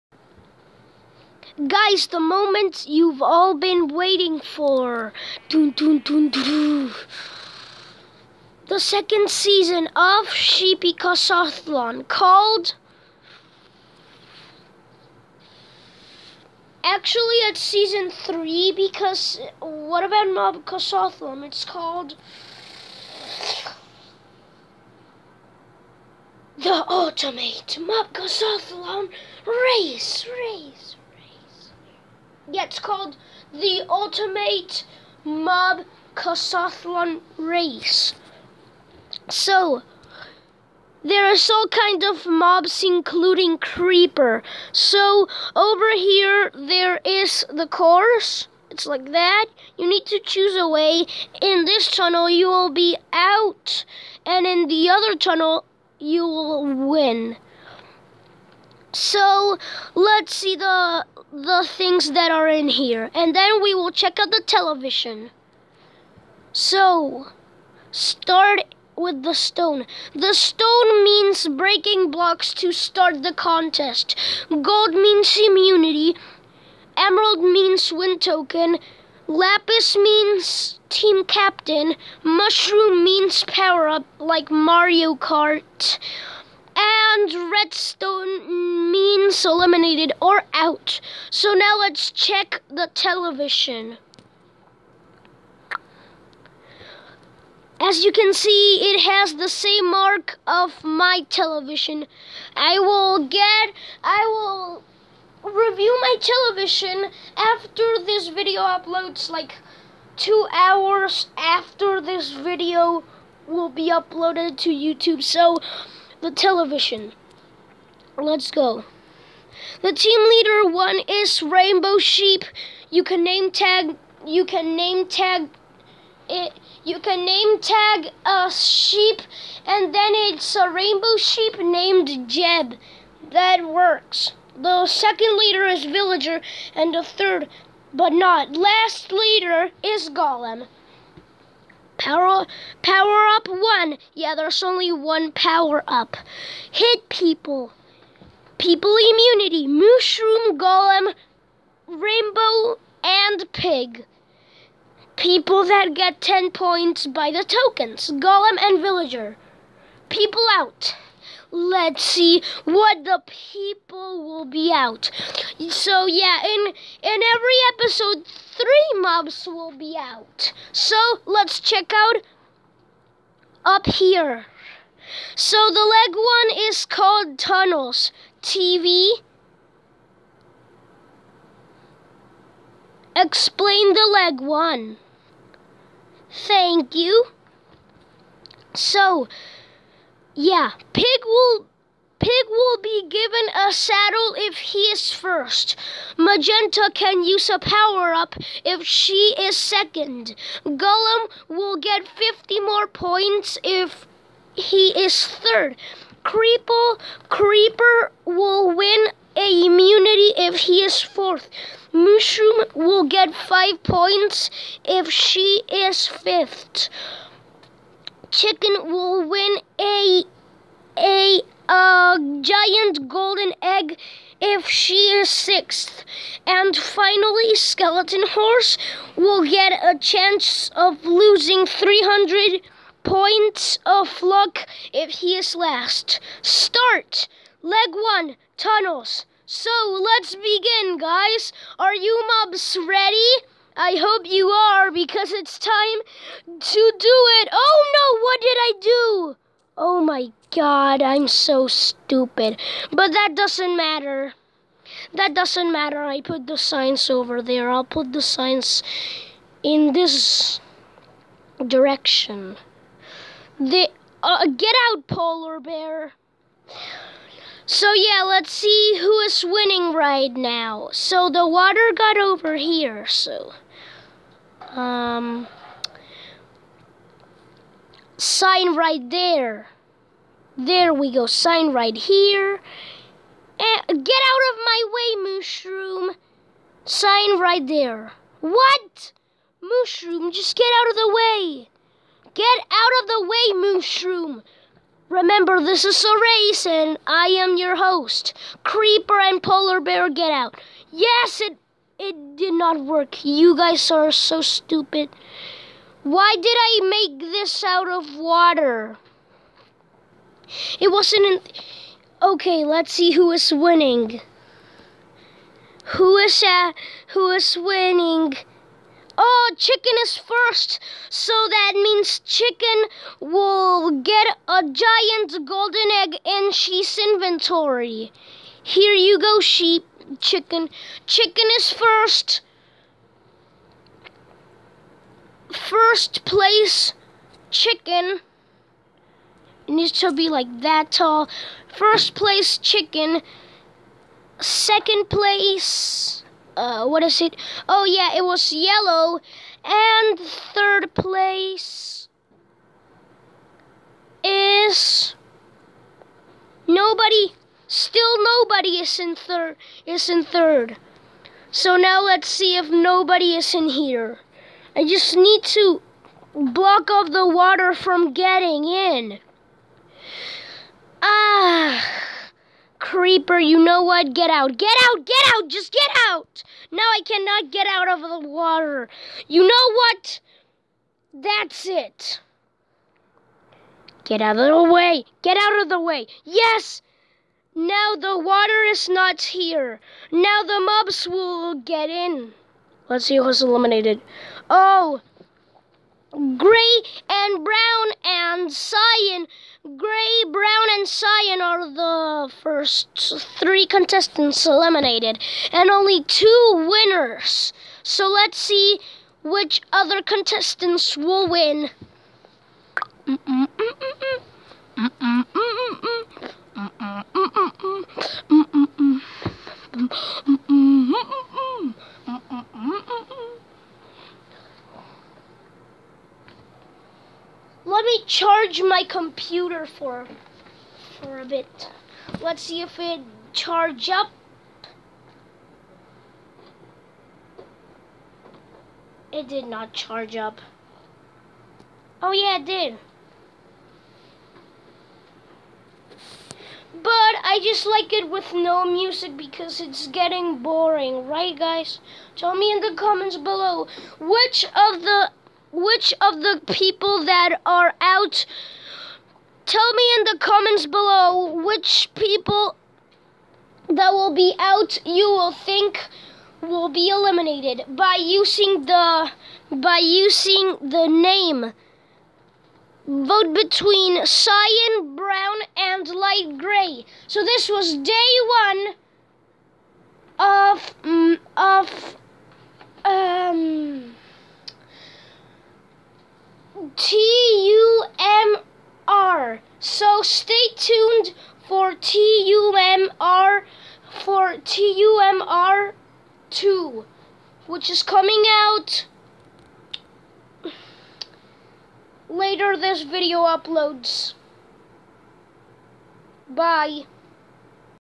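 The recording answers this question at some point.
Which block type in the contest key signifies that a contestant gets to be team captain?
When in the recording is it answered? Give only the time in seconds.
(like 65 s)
79 s.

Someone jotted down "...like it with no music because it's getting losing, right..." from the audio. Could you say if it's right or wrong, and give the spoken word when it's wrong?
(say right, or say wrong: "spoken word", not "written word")
wrong: "boring", not "losing".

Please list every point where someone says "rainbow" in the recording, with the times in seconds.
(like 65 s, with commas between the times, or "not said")
121 s, 130 s, 151 s.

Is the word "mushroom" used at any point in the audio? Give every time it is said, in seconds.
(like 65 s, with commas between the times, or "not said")
82 s, 149 s, 211 s, 285 s, 289 s, 293 s.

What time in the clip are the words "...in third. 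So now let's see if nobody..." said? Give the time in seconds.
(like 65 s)
360 s.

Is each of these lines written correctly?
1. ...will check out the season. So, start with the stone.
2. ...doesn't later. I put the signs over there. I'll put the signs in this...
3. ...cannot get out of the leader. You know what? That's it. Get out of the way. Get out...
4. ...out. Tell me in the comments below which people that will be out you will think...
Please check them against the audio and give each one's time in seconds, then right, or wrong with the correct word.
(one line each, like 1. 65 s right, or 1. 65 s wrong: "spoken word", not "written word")
1. 63 s wrong: "television", not "season"
2. 255 s wrong: "matter", not "later"
3. 377 s wrong: "water", not "leader"
4. 457 s right.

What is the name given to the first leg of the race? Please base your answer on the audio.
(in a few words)
Tunnels TV.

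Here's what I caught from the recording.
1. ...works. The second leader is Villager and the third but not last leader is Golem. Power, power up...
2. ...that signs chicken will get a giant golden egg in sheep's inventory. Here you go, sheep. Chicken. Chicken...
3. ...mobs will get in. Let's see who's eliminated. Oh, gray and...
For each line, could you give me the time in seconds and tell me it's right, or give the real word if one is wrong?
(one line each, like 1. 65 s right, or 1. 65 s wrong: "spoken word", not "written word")
1. 133 s right
2. 321 s wrong: "means", not "signs"
3. 390 s right.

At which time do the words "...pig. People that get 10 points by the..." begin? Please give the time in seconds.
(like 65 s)
153 s.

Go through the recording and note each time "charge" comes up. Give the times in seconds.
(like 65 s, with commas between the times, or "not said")
428 s, 433 s, 439 s.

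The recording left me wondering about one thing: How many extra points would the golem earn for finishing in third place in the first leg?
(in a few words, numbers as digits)
50.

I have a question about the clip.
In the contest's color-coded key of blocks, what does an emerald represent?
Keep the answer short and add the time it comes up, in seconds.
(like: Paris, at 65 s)
Win token, at 76 s.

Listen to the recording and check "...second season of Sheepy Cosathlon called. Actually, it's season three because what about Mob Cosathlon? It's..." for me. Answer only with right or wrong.
right.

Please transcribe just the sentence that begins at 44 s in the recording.
So, over here there is the course.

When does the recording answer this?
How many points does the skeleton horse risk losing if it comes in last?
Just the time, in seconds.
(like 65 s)
231 s.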